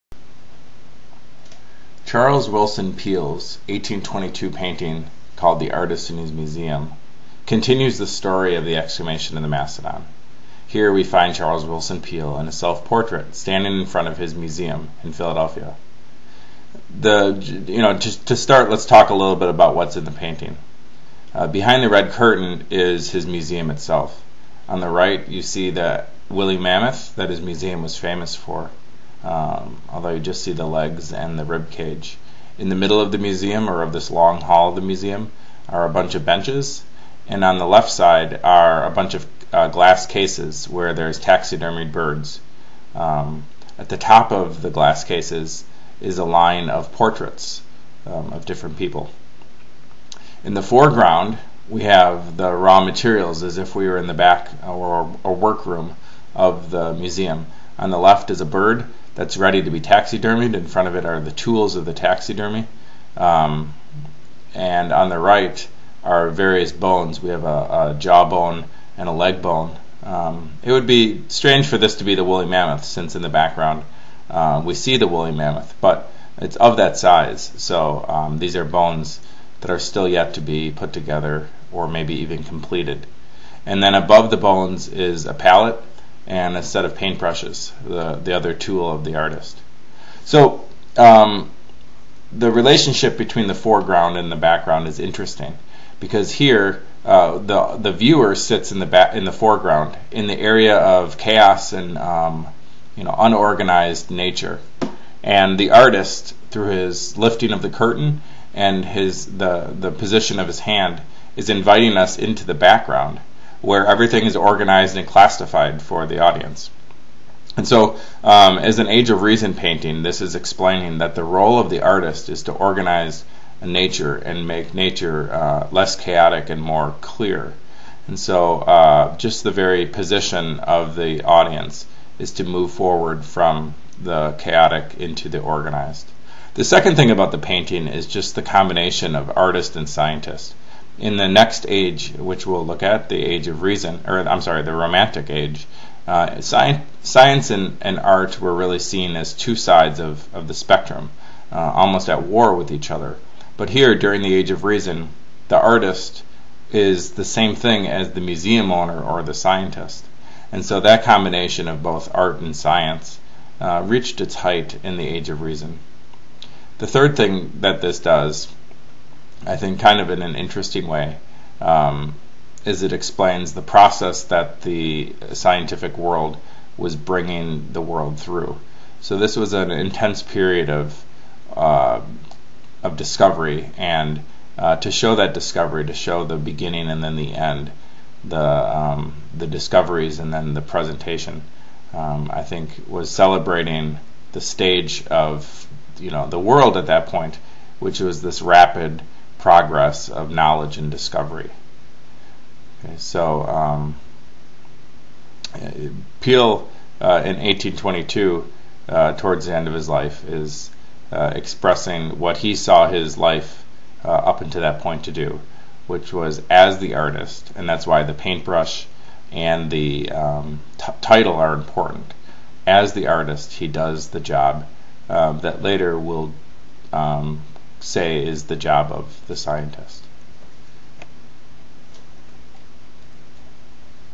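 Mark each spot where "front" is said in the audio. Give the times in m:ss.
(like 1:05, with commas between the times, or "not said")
0:13, 1:00.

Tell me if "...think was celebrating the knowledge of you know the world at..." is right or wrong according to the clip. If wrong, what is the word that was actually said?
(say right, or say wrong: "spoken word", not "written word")
wrong: "stage", not "knowledge".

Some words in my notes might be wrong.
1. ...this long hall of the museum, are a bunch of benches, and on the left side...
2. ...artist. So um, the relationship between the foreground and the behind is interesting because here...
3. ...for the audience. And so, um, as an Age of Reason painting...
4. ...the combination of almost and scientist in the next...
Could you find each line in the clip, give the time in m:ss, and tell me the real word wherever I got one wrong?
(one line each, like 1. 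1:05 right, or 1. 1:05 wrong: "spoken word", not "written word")
1. 0:33 right
2. 1:29 wrong: "background", not "behind"
3. 1:55 right
4. 2:18 wrong: "artist", not "almost".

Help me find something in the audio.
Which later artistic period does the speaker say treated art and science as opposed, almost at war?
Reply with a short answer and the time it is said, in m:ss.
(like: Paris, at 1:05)
The Romantic Age, at 2:24.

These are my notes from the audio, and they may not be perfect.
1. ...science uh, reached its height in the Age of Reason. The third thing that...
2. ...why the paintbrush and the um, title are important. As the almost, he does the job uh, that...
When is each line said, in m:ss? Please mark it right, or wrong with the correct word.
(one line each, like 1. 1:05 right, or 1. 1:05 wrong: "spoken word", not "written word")
1. 2:42 right
2. 3:37 wrong: "artist", not "almost".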